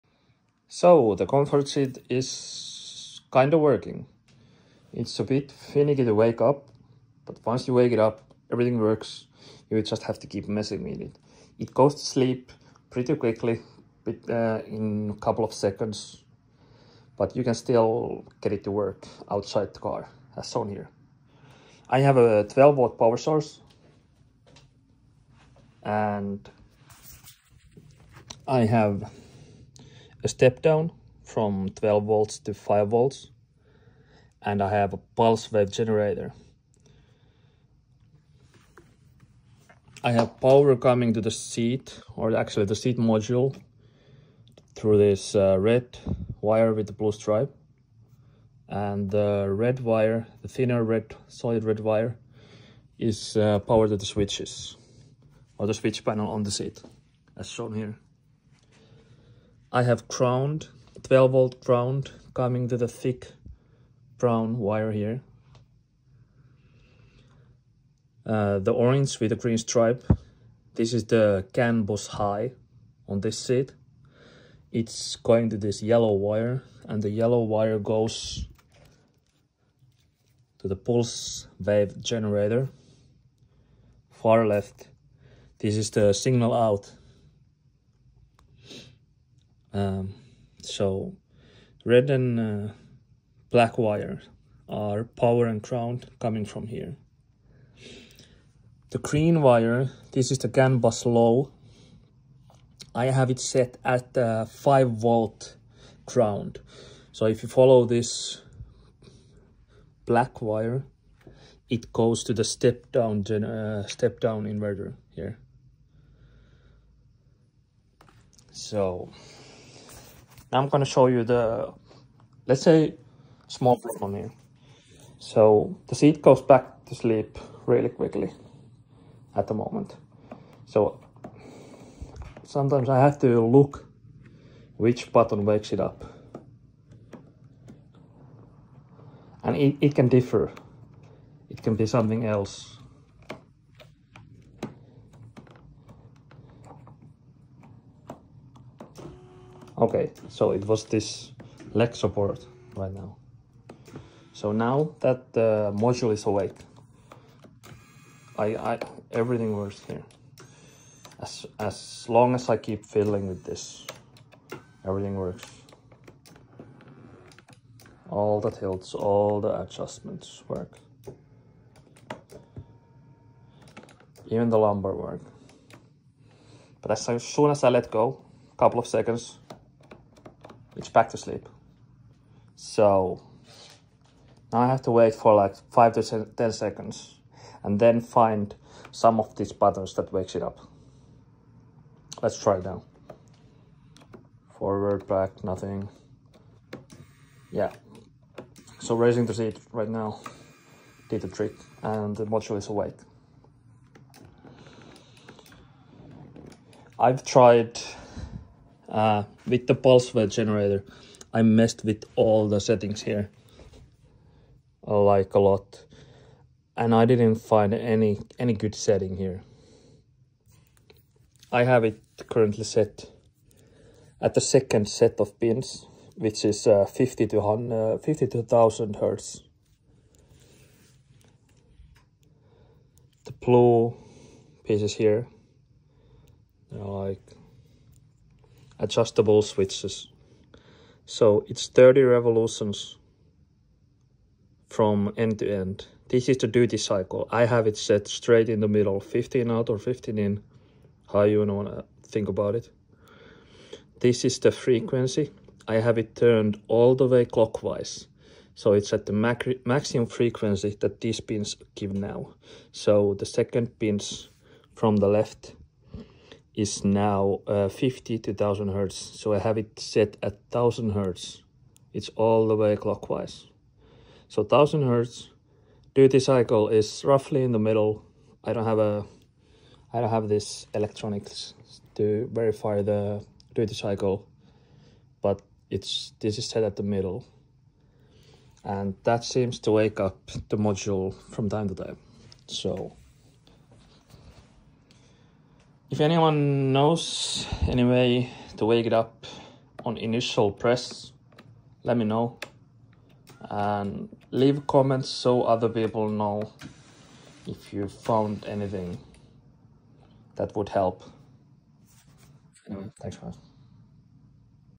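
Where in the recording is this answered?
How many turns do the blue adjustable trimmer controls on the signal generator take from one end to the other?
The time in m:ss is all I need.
4:01.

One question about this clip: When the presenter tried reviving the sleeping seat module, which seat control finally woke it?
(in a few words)
leg support.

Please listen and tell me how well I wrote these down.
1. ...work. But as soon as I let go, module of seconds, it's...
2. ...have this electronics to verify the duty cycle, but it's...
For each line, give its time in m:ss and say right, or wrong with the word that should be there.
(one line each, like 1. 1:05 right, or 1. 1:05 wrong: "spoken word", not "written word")
1. 2:54 wrong: "couple", not "module"
2. 4:40 right.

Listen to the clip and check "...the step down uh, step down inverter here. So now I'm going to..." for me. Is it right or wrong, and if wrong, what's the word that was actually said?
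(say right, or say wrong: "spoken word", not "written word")
right.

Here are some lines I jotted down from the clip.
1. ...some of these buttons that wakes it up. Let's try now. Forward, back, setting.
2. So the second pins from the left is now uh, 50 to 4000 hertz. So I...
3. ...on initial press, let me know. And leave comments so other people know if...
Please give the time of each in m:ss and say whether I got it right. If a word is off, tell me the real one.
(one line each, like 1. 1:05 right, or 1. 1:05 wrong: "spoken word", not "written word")
1. 3:08 wrong: "nothing", not "setting"
2. 4:22 wrong: "1000", not "4000"
3. 4:59 right.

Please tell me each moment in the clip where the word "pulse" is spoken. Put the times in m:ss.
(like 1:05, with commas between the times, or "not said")
0:34, 1:20, 3:29.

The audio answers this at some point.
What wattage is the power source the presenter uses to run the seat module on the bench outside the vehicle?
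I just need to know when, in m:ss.
0:22.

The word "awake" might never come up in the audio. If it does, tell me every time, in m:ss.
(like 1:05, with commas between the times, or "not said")
2:36, 3:22.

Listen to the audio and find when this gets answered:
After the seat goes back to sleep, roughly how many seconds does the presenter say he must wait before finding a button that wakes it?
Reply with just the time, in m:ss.
3:05.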